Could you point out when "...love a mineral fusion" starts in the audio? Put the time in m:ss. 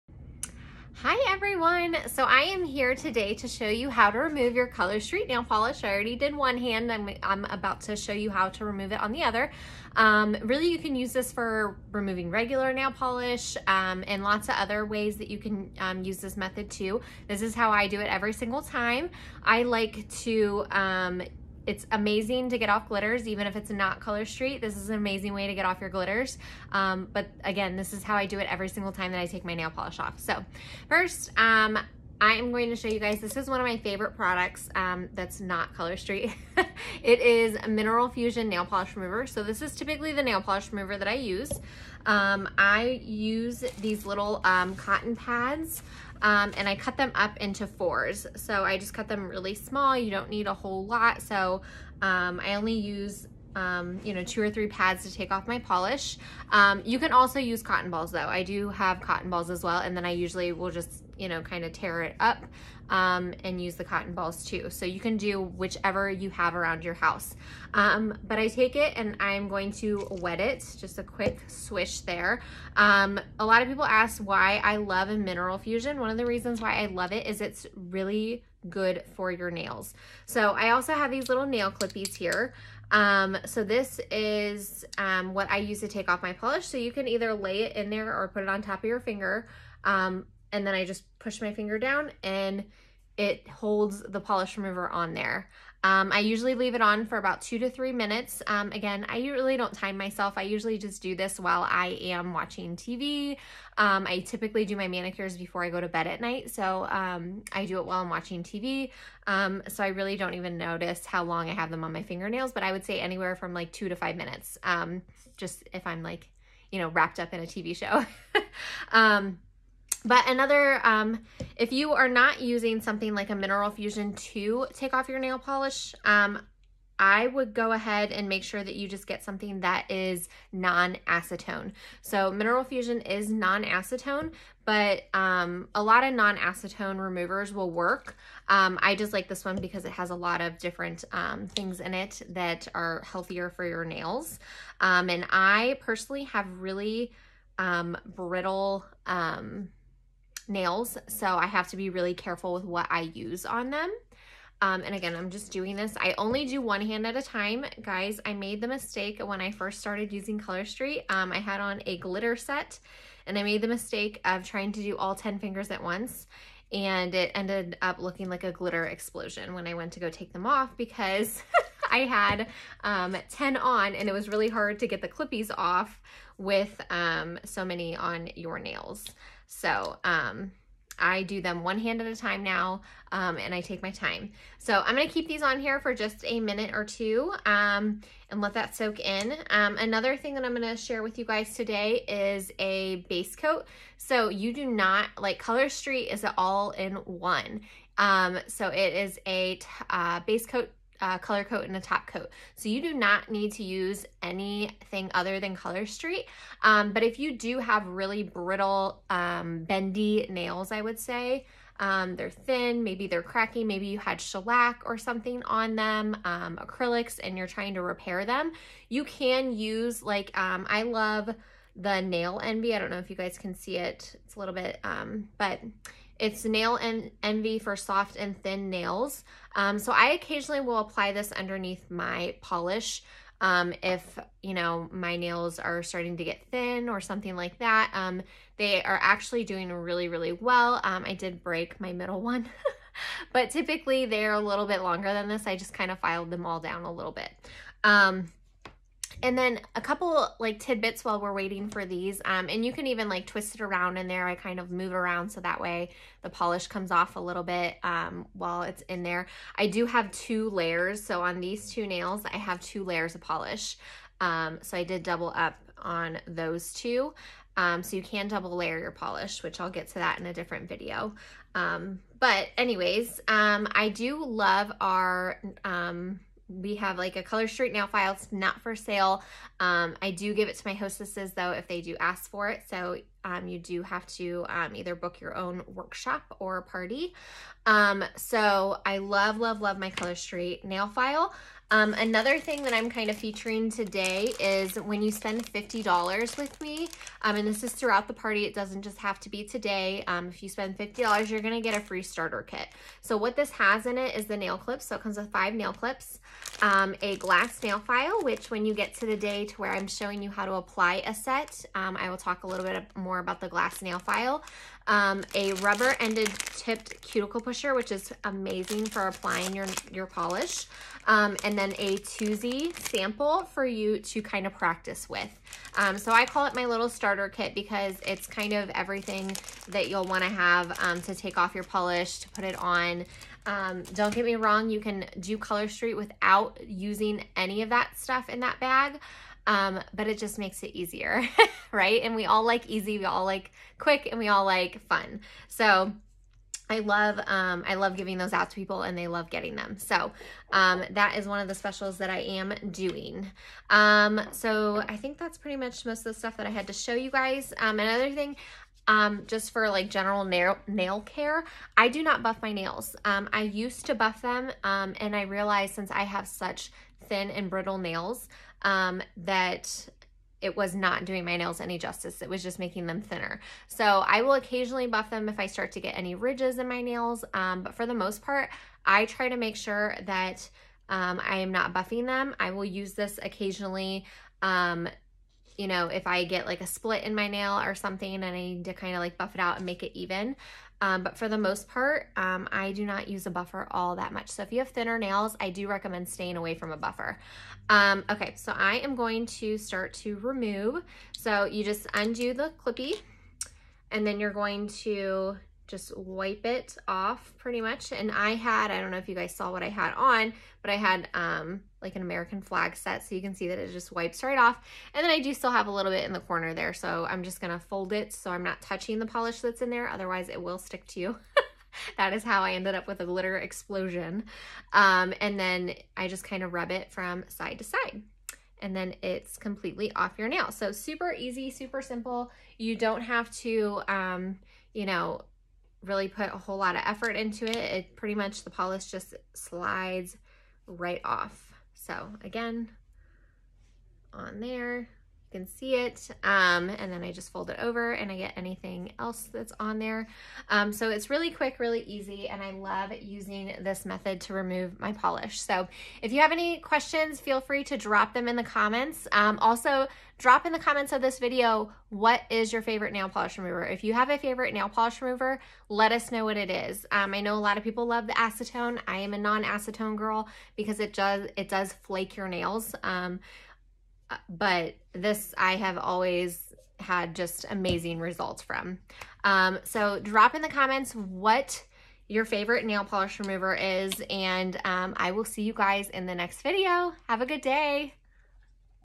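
1:14.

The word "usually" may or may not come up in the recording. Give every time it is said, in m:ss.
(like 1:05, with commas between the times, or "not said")
1:00, 1:36, 1:40.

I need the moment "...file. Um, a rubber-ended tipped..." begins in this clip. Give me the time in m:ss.
5:13.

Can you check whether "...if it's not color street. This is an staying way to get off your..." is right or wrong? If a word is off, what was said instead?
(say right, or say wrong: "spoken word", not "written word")
wrong: "amazing", not "staying".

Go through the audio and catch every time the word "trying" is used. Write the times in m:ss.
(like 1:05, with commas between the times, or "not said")
2:44, 3:37.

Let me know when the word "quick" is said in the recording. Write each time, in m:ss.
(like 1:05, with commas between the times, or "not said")
1:11, 5:43, 7:31.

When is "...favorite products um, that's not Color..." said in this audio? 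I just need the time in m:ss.
0:33.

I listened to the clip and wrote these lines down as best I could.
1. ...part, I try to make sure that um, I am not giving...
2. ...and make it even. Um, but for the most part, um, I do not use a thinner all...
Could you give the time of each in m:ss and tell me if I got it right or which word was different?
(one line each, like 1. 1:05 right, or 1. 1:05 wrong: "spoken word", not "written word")
1. 6:18 wrong: "buffing", not "giving"
2. 6:29 wrong: "buffer", not "thinner".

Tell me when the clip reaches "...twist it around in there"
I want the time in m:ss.
4:13.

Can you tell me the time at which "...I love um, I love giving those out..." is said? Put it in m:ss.
5:46.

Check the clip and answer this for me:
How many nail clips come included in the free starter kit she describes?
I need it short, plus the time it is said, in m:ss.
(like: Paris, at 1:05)
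5, at 5:05.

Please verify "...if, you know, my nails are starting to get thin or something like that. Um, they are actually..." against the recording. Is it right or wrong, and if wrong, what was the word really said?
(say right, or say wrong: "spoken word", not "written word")
right.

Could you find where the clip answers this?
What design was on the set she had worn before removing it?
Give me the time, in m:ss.
6:52.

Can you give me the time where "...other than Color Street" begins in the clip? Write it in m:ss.
3:25.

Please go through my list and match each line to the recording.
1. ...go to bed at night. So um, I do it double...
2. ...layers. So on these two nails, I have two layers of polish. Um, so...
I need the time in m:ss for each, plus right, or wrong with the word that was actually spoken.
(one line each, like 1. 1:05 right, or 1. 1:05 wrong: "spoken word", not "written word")
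1. 1:45 wrong: "while", not "double"
2. 4:20 right.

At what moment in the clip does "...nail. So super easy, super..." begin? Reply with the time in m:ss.
7:10.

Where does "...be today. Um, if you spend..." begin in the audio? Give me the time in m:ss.
4:59.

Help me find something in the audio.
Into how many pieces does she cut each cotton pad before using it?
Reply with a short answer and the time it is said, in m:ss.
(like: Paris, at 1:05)
4, at 0:46.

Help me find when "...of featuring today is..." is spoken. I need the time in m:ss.
4:53.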